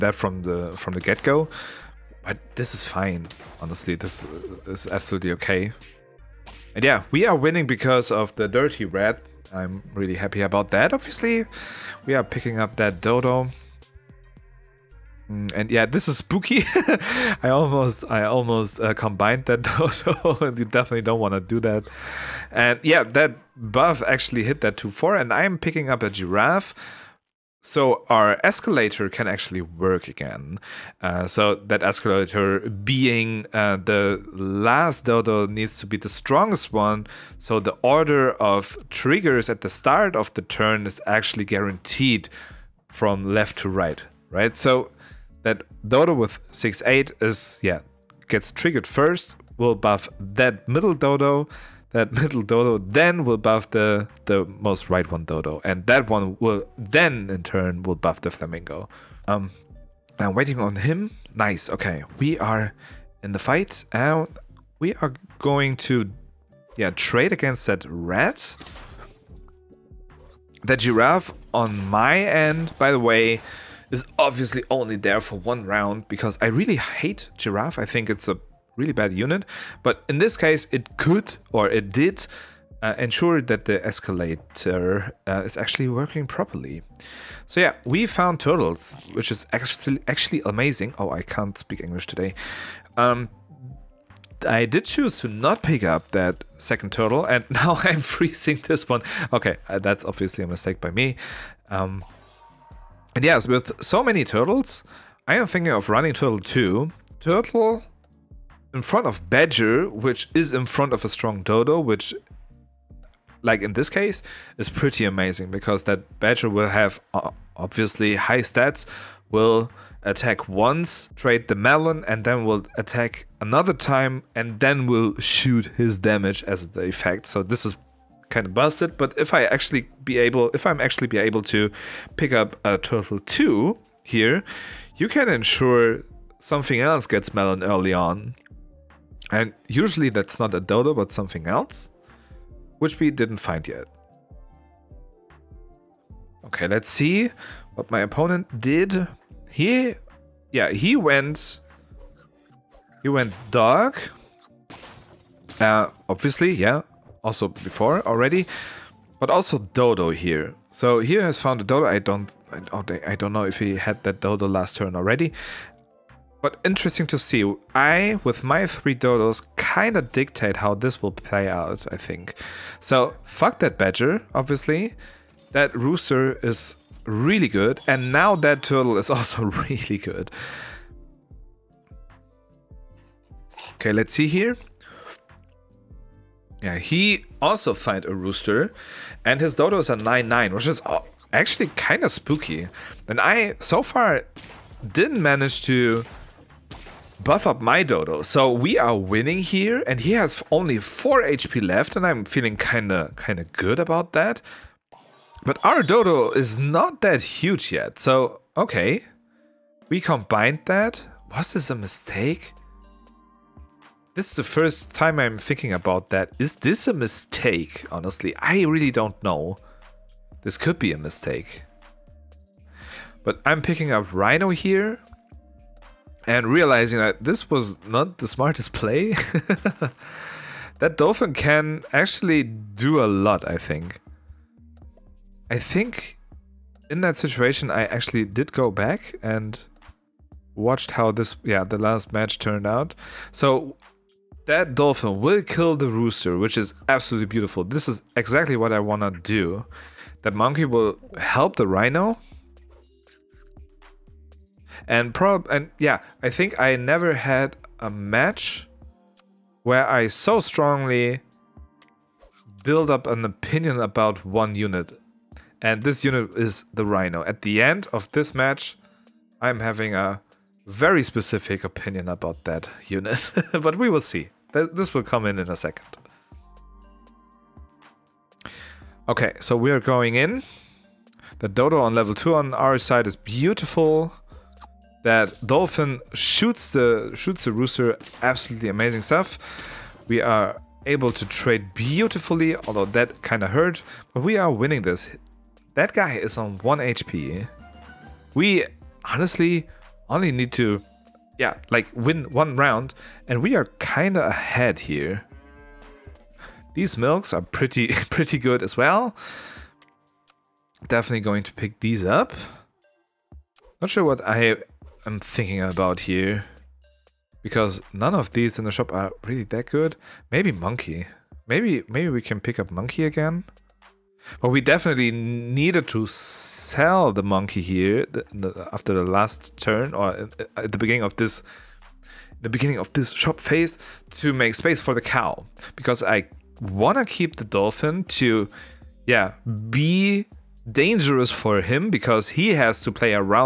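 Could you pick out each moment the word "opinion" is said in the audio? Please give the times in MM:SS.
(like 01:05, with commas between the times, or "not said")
04:23, 04:31.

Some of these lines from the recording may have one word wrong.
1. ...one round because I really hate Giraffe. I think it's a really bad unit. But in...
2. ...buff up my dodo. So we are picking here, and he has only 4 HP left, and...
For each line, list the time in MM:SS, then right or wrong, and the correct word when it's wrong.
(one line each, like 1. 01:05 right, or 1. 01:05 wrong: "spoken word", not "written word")
1. 01:15 right
2. 03:17 wrong: "winning", not "picking".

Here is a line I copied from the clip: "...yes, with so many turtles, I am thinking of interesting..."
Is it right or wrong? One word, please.
wrong.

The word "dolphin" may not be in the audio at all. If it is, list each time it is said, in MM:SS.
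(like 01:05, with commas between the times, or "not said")
03:50, 04:04, 04:45, 05:37.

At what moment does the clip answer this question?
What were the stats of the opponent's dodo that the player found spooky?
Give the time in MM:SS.
03:09.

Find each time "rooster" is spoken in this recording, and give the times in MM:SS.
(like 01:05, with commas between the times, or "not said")
02:55, 03:08, 04:05, 04:47.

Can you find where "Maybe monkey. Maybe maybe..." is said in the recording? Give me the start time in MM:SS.
05:20.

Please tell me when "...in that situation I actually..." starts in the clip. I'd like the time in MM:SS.
03:56.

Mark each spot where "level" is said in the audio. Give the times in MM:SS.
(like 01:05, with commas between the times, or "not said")
04:41.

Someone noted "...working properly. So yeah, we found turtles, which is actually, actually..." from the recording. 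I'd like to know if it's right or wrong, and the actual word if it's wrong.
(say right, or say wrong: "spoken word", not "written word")
right.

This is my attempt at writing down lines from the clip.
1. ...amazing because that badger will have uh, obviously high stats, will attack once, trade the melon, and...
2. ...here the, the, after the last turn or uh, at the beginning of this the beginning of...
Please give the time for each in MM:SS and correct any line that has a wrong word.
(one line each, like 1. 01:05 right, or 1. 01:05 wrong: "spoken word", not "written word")
1. 01:55 right
2. 05:27 right.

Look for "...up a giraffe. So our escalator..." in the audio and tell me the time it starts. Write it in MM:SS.
00:25.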